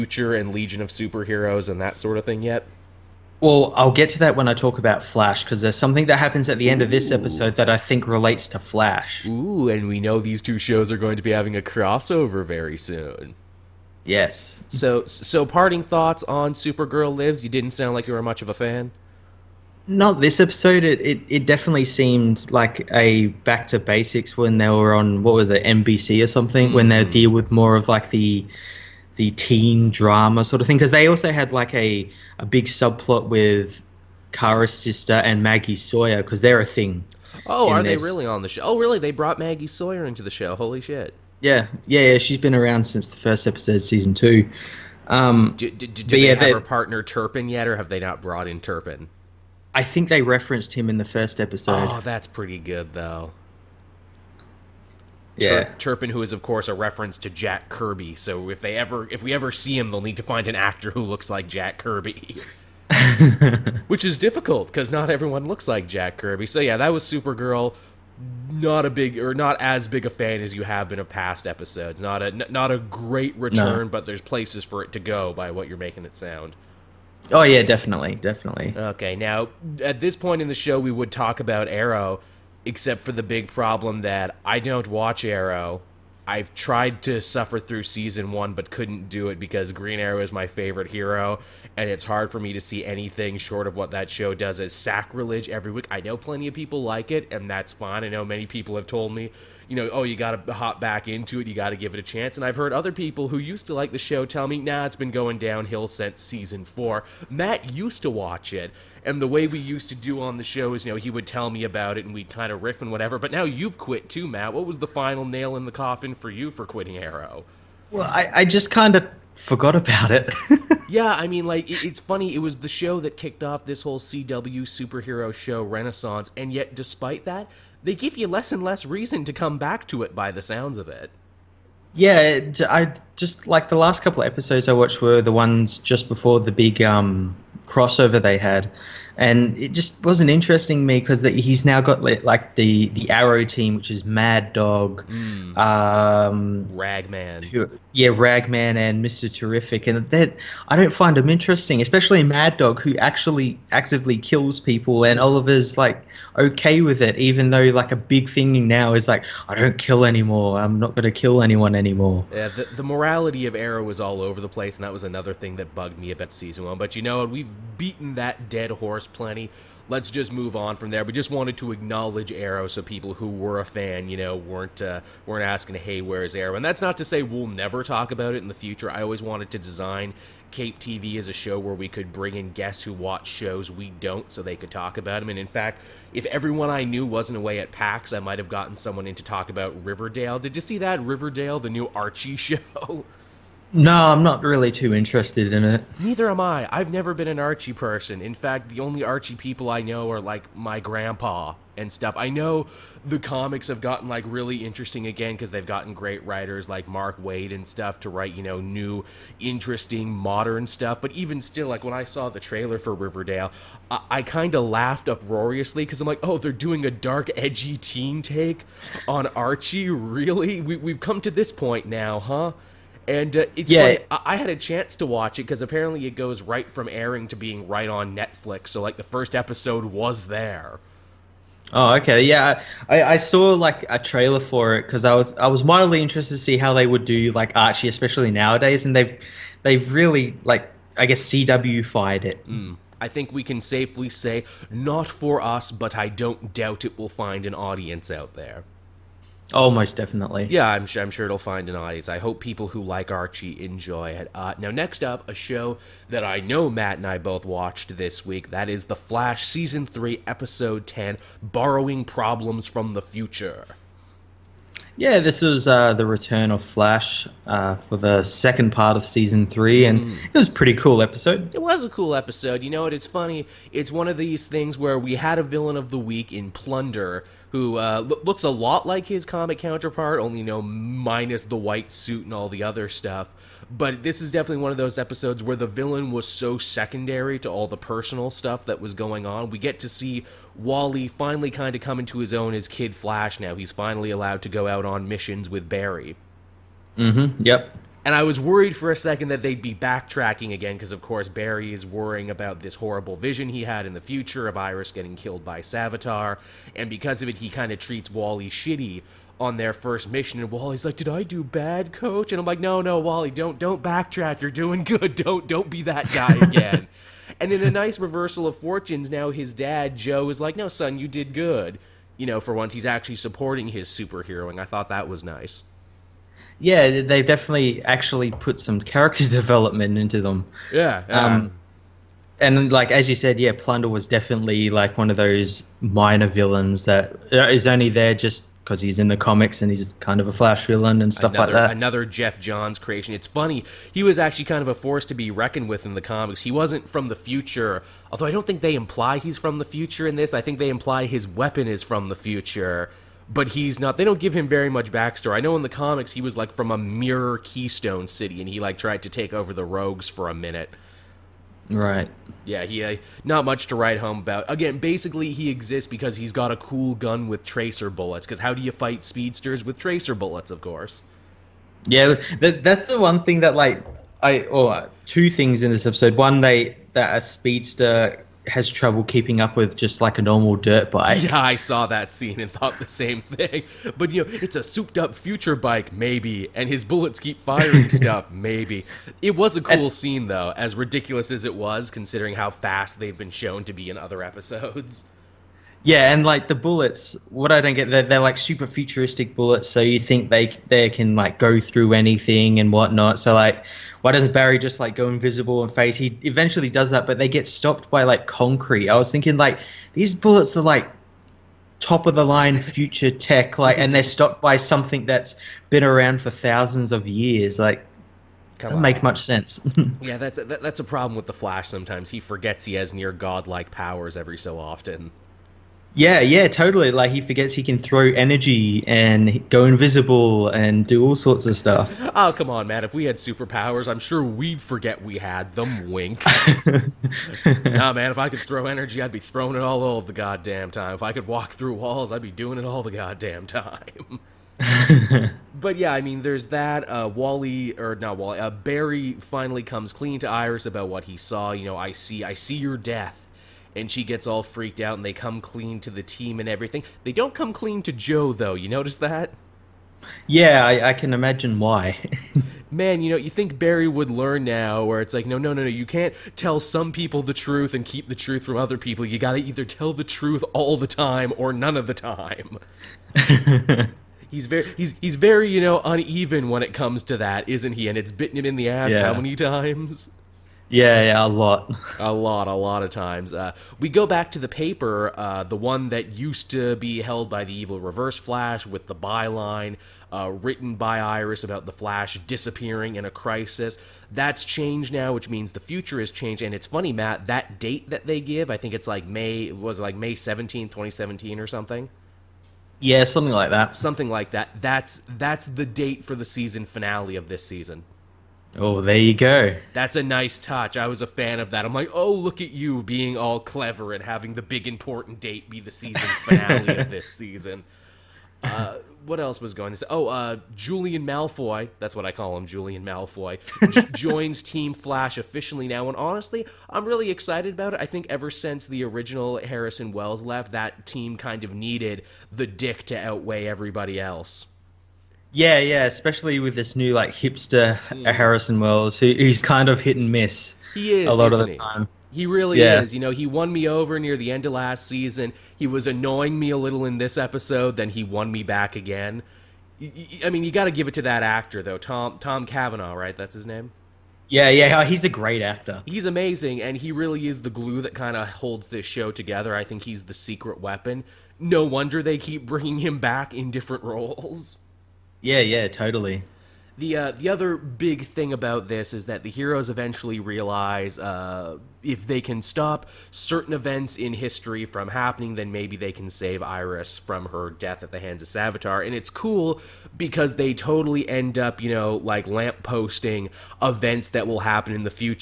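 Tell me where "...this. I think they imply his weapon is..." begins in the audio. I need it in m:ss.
5:50.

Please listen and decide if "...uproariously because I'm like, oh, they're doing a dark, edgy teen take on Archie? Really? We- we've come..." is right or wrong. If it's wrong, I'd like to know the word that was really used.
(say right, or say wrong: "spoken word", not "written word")
right.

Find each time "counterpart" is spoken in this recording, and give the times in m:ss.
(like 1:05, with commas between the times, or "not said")
4:39.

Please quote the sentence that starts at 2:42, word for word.
Yeah, the, the morality of Arrow was all over the place, and that was another thing that bugged me about season one.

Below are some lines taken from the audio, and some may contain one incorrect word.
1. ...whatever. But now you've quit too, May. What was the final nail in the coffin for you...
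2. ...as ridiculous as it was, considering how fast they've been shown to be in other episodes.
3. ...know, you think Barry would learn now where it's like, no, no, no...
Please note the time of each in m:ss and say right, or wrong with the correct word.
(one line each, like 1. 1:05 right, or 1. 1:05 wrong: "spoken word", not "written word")
1. 1:52 wrong: "Matt", not "May"
2. 6:30 right
3. 7:43 right.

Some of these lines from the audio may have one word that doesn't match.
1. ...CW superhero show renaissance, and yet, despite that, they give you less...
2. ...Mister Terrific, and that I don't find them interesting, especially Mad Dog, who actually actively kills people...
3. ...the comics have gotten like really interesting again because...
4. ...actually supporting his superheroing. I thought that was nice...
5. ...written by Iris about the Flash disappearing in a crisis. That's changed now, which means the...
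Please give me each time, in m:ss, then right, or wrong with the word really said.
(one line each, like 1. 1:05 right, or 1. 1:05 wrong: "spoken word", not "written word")
1. 2:03 right
2. 2:29 right
3. 3:23 right
4. 5:22 right
5. 8:10 right.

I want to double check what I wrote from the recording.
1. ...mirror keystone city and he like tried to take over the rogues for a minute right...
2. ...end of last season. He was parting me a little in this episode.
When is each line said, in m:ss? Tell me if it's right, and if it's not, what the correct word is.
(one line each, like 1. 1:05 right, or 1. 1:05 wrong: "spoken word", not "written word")
1. 5:56 right
2. 9:04 wrong: "annoying", not "parting".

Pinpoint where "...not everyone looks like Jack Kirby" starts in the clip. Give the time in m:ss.
1:04.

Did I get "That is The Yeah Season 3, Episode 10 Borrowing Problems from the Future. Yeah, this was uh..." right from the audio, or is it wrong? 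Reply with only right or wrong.
wrong.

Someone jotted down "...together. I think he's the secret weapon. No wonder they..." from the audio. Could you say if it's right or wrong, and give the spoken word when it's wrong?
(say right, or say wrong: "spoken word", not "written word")
right.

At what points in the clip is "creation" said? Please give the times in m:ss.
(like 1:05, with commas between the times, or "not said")
5:42.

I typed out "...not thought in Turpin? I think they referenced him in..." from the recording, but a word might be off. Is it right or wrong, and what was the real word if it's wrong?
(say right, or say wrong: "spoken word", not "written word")
wrong: "brought", not "thought".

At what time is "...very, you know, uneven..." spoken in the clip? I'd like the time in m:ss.
7:55.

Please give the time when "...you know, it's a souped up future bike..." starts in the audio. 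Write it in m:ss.
6:24.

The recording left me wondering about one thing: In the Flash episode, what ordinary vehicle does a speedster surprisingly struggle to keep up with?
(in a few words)
dirt bike.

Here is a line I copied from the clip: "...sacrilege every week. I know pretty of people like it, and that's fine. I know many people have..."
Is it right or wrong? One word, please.
wrong.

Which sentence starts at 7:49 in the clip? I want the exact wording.
You gotta either tell the truth all the time or none of the time.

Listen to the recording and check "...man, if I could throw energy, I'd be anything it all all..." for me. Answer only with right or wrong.
wrong.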